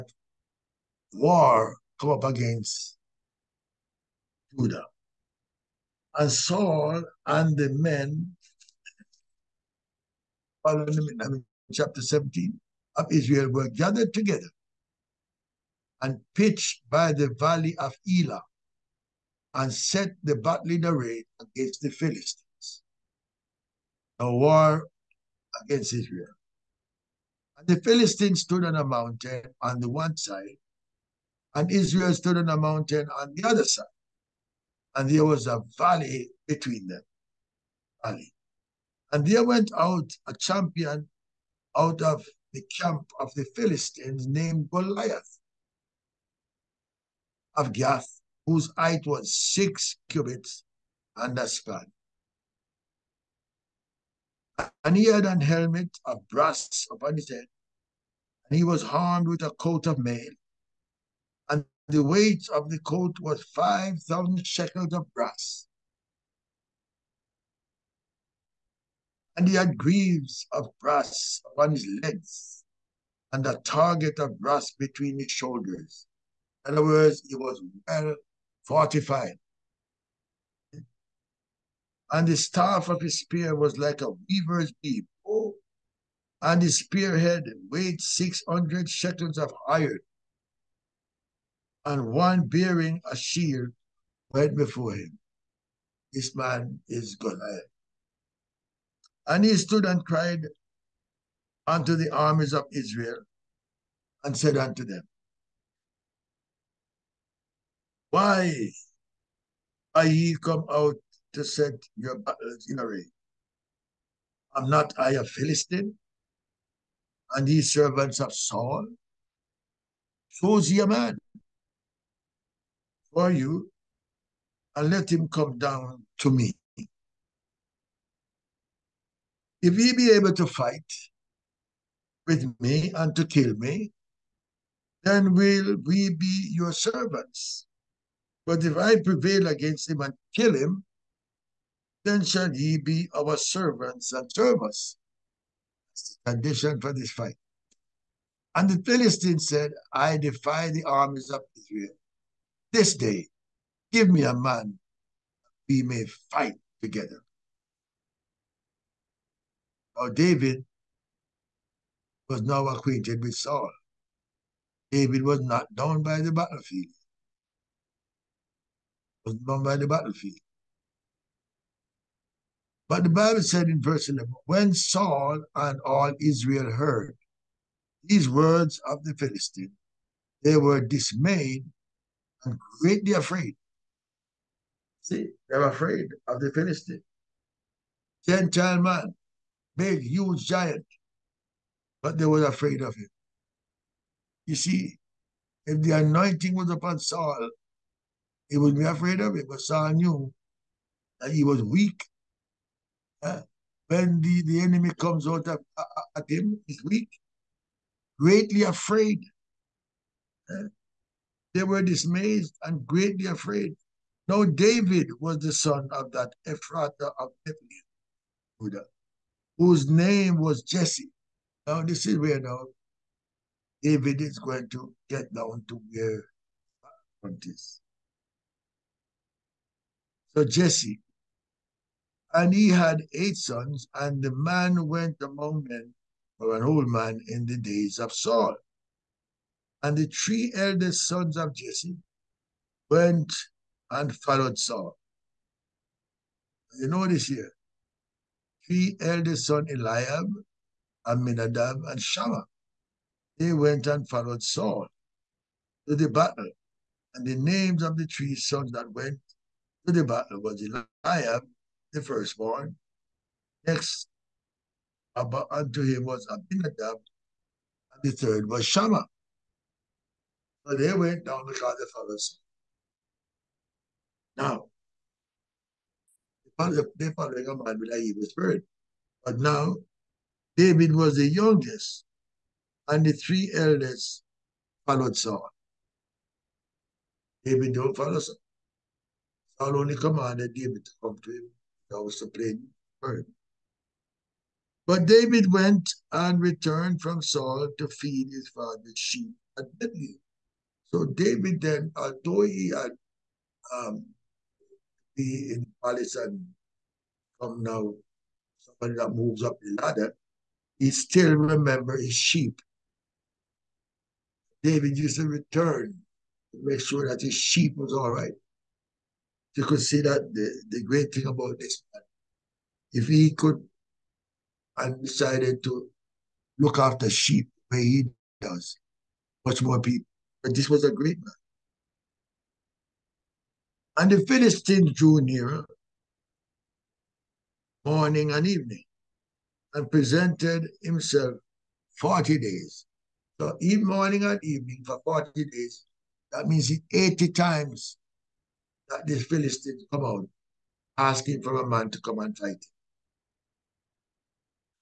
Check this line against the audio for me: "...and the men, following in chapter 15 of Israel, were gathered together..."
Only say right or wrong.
wrong.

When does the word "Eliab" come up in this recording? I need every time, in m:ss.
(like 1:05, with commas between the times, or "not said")
4:09, 4:20.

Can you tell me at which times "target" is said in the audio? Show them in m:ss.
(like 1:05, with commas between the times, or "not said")
1:13.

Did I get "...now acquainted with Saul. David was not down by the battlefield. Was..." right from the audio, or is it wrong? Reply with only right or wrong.
right.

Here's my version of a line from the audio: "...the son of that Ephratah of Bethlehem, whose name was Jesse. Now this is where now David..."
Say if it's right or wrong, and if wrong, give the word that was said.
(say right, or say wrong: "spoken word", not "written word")
right.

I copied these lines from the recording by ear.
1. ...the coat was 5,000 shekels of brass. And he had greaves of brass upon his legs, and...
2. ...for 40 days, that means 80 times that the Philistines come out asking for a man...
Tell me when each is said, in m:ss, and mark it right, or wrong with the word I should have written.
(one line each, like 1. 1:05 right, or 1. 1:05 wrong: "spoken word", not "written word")
1. 1:02 right
2. 5:44 right.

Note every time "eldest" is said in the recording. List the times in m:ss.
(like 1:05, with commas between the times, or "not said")
4:00, 4:09, 4:43.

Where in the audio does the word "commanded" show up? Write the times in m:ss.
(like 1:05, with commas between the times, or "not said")
4:49.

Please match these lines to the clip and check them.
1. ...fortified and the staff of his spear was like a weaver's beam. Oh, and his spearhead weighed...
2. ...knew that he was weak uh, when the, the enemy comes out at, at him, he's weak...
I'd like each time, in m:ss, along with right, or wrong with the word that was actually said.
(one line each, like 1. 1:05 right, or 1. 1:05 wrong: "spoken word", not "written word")
1. 1:18 right
2. 3:19 right.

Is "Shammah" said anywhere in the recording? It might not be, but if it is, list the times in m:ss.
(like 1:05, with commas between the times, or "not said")
4:11, 4:28.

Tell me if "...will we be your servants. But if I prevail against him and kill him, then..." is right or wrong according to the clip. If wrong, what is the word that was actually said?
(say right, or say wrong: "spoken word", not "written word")
right.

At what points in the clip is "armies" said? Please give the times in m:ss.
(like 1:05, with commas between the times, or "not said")
1:42, 2:30.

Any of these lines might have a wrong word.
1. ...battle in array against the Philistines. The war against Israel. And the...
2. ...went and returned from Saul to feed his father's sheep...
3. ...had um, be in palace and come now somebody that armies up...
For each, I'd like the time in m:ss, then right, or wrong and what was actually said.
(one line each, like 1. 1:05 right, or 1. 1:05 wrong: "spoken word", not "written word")
1. 0:20 right
2. 4:55 right
3. 5:02 wrong: "moves", not "armies".